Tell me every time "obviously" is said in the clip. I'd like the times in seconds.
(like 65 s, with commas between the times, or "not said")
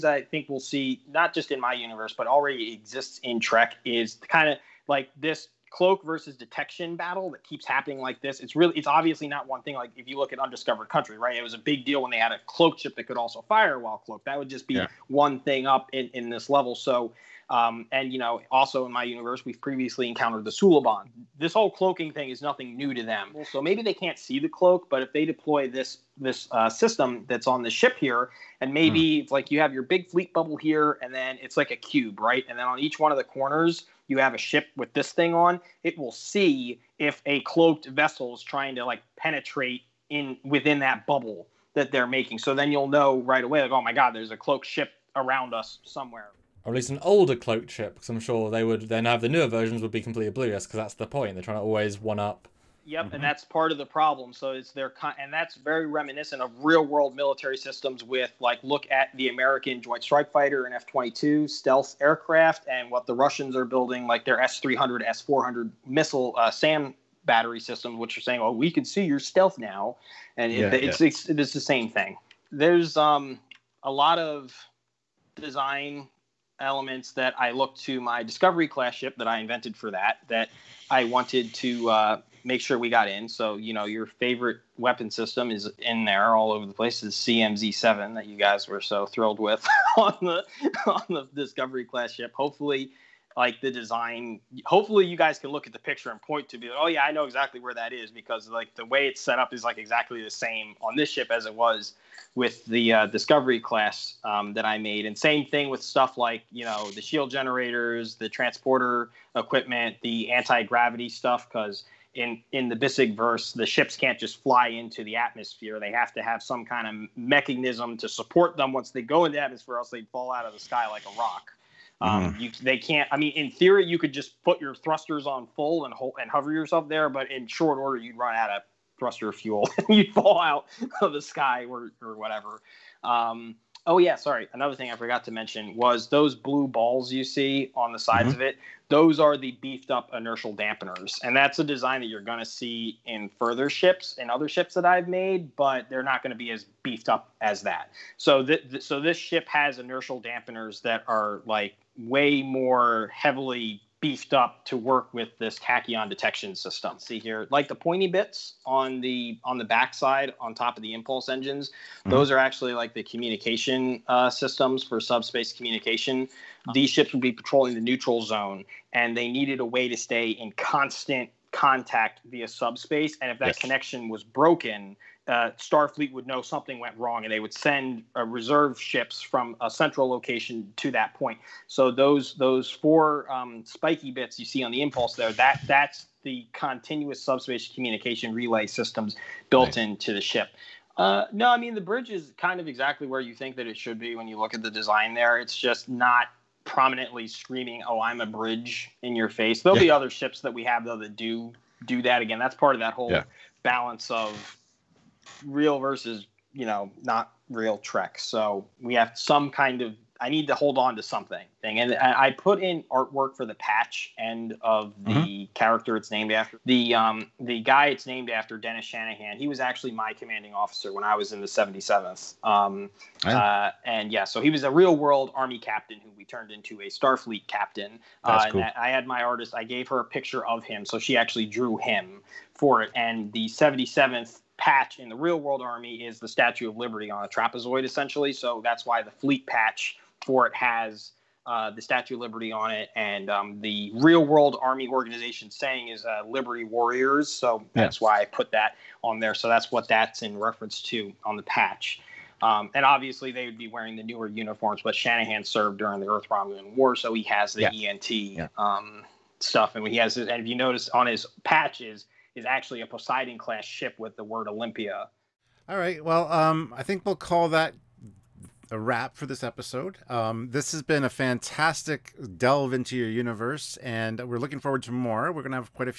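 8 s, 252 s.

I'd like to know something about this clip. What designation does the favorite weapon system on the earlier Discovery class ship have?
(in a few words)
CMZ7.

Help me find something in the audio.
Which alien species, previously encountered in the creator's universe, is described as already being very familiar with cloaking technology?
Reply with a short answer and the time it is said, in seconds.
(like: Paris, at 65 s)
Suliban, at 20 s.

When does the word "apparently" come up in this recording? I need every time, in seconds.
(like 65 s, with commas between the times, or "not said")
not said.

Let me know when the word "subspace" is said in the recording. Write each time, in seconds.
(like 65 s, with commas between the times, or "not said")
165 s, 172 s, 187 s.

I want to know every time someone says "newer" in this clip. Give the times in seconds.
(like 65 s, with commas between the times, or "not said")
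49 s, 254 s.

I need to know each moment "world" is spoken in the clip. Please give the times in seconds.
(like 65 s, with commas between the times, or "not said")
56 s, 224 s, 235 s, 244 s.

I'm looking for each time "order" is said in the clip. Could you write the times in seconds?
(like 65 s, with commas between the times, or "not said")
127 s.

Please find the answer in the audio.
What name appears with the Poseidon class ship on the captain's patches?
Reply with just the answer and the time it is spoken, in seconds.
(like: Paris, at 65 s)
Olympia, at 264 s.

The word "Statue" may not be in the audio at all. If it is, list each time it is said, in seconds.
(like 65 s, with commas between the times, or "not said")
236 s, 241 s.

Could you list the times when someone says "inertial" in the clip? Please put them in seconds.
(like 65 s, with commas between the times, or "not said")
140 s, 149 s.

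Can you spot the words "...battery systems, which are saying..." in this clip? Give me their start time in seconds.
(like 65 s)
67 s.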